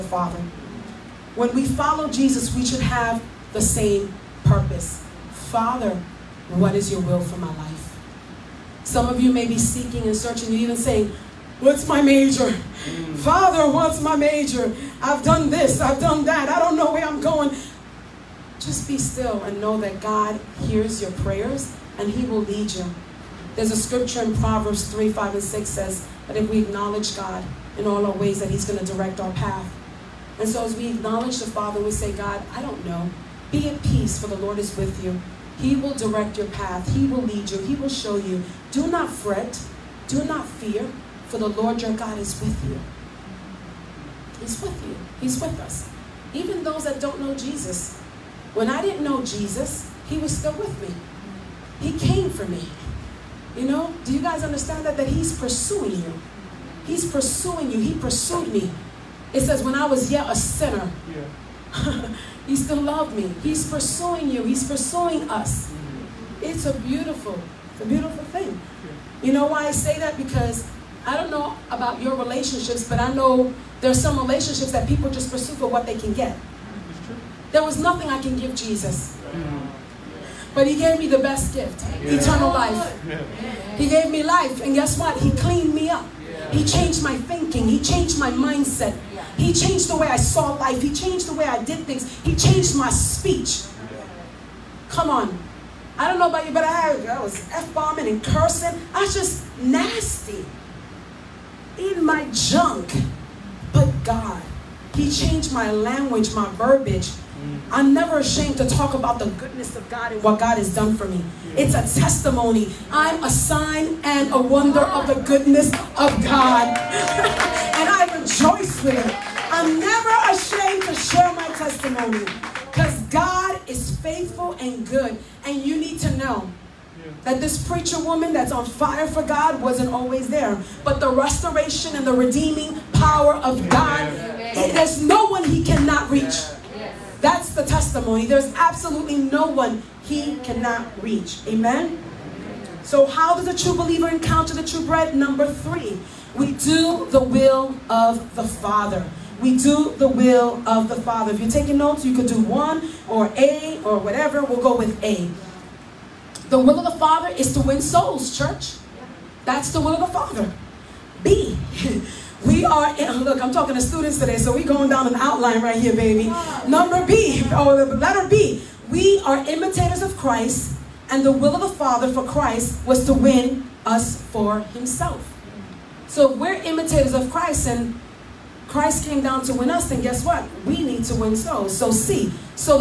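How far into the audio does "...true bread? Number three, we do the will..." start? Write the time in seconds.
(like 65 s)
144 s.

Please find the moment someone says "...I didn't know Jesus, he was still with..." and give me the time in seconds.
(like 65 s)
48 s.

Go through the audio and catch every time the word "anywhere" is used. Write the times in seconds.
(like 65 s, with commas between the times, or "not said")
not said.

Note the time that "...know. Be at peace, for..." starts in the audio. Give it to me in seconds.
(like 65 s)
32 s.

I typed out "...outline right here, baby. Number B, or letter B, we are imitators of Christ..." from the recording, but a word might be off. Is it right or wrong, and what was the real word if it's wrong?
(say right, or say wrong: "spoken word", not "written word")
right.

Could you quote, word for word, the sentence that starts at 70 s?
Because I don't know about your relationships, but I know there's some relationships that people just pursue for what they can get.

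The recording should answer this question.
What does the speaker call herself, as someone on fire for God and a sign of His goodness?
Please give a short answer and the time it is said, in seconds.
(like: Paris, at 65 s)
preacher woman, at 127 s.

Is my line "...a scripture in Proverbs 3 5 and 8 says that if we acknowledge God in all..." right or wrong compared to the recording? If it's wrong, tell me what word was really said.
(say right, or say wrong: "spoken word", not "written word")
wrong: "6", not "8".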